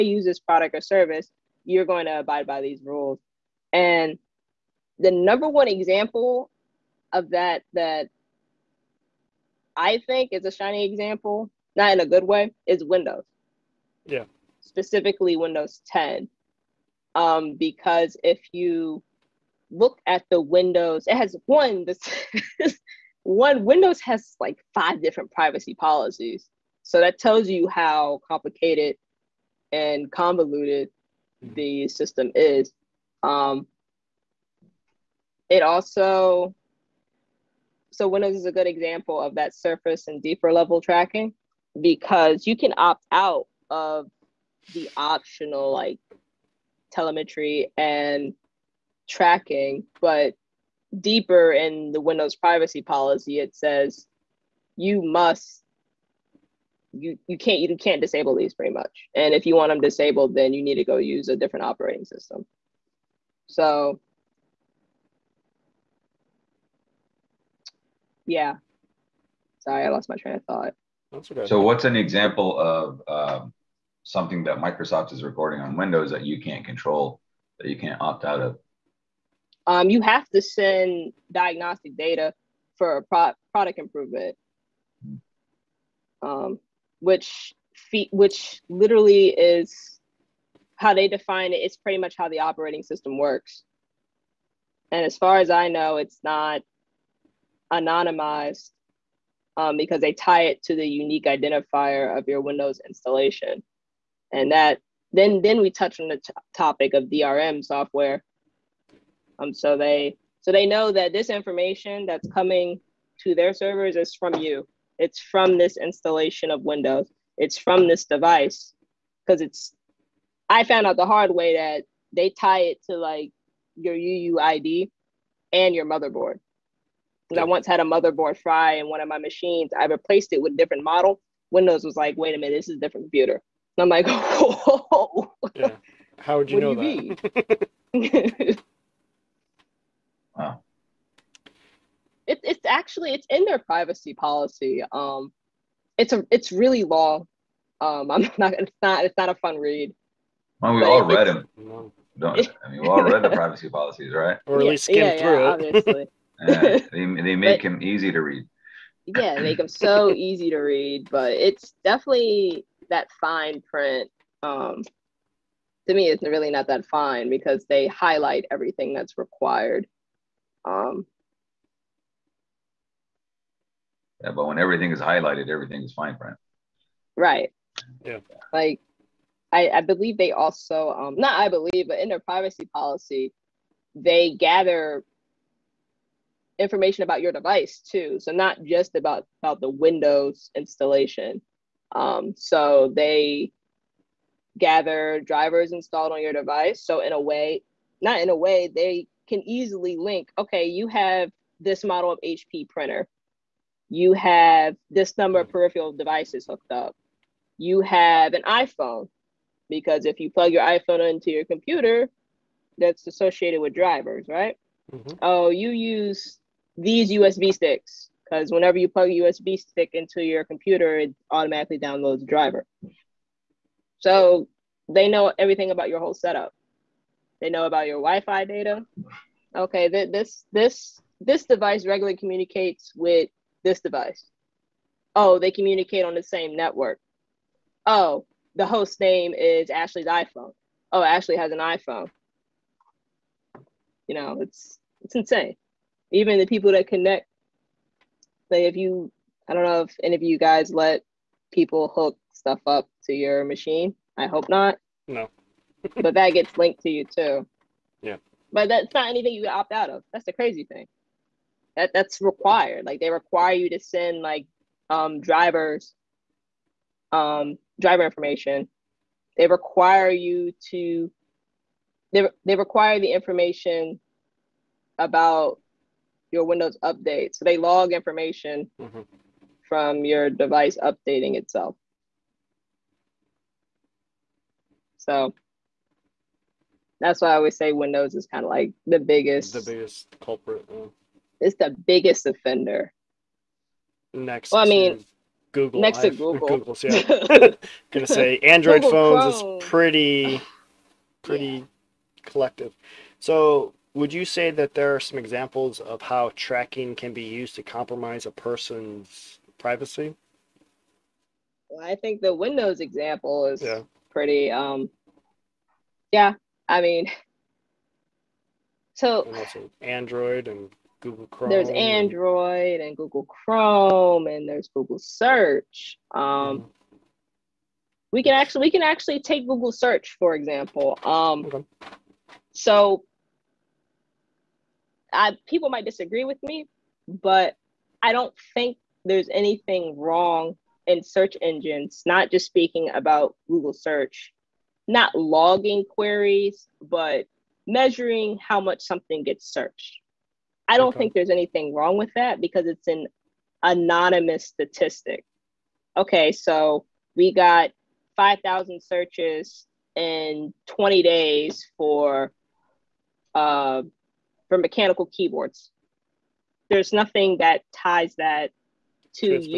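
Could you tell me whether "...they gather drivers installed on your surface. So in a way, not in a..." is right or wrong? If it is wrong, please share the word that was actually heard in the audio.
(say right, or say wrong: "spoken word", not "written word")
wrong: "device", not "surface".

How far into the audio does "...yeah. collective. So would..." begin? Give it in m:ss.
5:01.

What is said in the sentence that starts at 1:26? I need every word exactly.
um, which fe- which literally is how they define it.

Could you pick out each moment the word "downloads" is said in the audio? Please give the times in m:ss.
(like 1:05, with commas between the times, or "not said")
3:41.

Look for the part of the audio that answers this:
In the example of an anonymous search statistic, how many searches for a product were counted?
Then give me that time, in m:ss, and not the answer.
5:58.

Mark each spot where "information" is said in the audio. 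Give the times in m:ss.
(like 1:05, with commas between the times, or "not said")
1:51, 3:06, 4:28, 4:33, 4:37.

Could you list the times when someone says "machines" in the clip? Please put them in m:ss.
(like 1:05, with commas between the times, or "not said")
2:09, 4:13.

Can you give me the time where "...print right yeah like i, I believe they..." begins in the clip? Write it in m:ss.
2:56.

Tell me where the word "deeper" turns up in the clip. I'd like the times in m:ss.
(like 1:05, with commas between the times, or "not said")
0:40, 0:50.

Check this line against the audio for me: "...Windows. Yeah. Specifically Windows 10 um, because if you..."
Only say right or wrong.
right.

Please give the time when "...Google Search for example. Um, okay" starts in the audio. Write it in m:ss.
5:29.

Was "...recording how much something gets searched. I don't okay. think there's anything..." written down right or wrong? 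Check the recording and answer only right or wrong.
wrong.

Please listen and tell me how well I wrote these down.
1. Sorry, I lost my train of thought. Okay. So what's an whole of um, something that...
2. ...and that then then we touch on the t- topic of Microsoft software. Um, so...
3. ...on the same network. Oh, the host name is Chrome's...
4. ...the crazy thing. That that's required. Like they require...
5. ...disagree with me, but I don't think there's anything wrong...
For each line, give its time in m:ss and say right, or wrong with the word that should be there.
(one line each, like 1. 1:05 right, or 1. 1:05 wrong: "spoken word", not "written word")
1. 1:09 wrong: "example", not "whole"
2. 1:44 wrong: "DRM", not "Microsoft"
3. 3:56 wrong: "Ashley", not "Chrome"
4. 4:20 right
5. 5:35 right.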